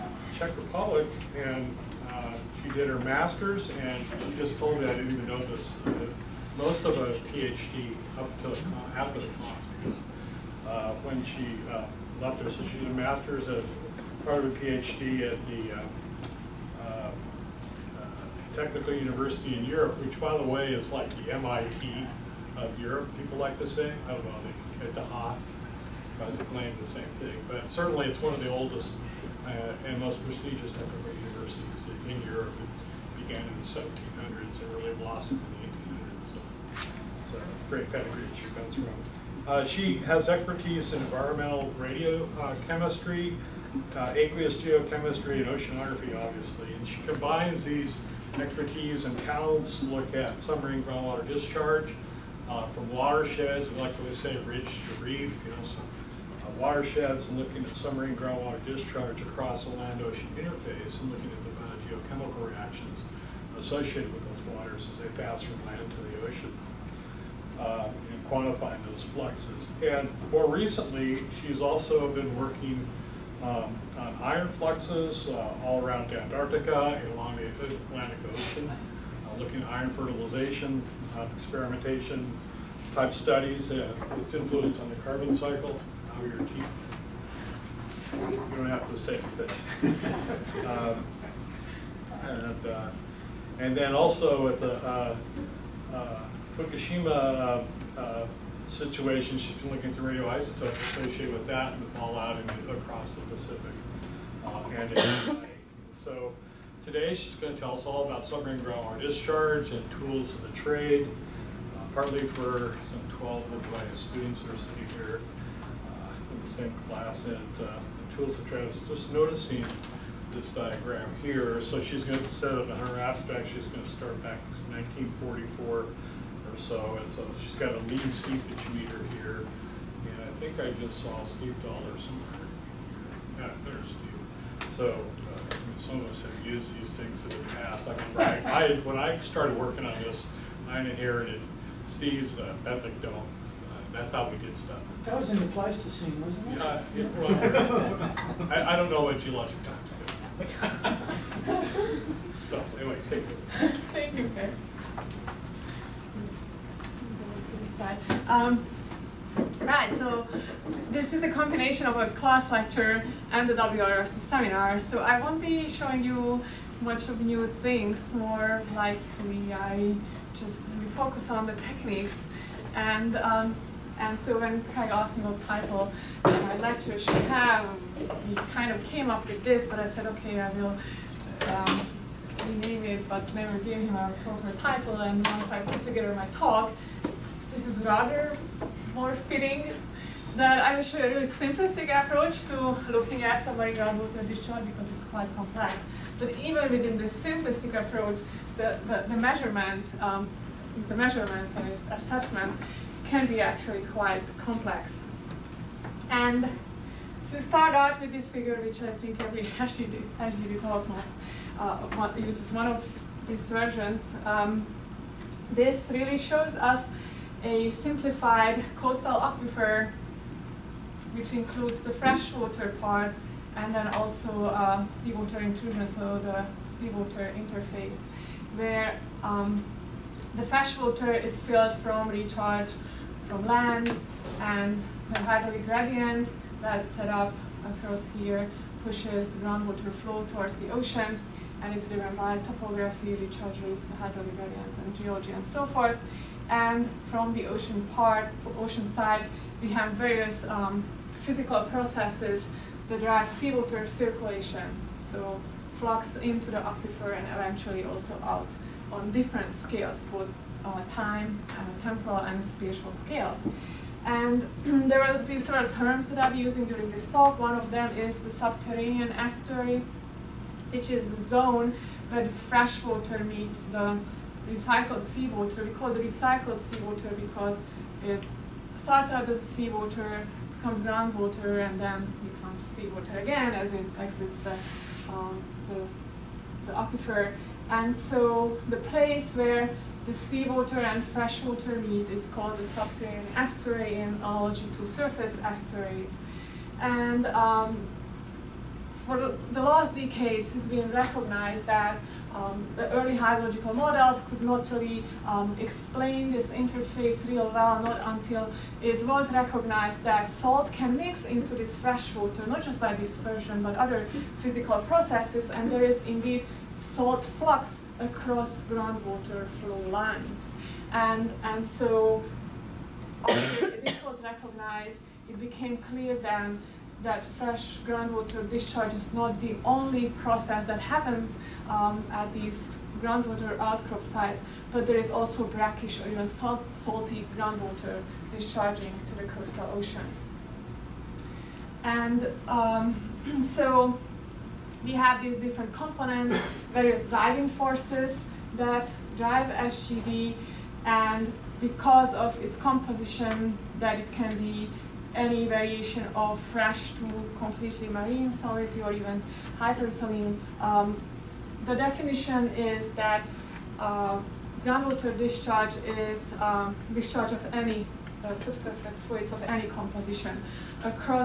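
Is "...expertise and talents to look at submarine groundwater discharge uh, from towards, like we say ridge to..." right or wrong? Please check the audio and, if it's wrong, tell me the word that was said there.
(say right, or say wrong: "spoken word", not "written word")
wrong: "watersheds", not "towards".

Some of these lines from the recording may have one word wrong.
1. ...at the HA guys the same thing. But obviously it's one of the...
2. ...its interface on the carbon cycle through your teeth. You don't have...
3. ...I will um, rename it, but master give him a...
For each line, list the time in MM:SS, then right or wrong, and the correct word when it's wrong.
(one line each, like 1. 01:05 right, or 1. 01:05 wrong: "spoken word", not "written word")
1. 00:24 wrong: "certainly", not "obviously"
2. 01:24 wrong: "influence", not "interface"
3. 03:00 wrong: "never", not "master".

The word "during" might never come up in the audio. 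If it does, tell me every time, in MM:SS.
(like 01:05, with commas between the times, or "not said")
04:26.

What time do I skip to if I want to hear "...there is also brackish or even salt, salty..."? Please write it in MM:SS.
05:34.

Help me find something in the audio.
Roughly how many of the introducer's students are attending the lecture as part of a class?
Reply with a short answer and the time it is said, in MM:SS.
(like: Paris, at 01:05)
12, at 01:53.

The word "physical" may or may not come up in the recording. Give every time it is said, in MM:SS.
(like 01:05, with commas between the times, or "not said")
04:11, 05:14.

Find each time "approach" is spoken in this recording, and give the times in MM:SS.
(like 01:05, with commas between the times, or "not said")
03:11, 03:17.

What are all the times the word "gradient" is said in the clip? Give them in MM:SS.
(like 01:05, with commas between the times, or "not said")
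03:55, 04:04.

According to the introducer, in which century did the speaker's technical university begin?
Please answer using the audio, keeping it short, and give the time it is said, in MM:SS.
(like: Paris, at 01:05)
1700s, at 00:33.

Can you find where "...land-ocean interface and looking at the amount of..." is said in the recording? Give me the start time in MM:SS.
00:59.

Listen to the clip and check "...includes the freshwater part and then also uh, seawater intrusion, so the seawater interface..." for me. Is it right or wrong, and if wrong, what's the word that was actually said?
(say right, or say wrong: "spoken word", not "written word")
right.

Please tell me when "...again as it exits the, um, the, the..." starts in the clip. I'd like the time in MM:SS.
04:43.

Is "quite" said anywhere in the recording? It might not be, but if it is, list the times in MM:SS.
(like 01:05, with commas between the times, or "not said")
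03:15, 03:23.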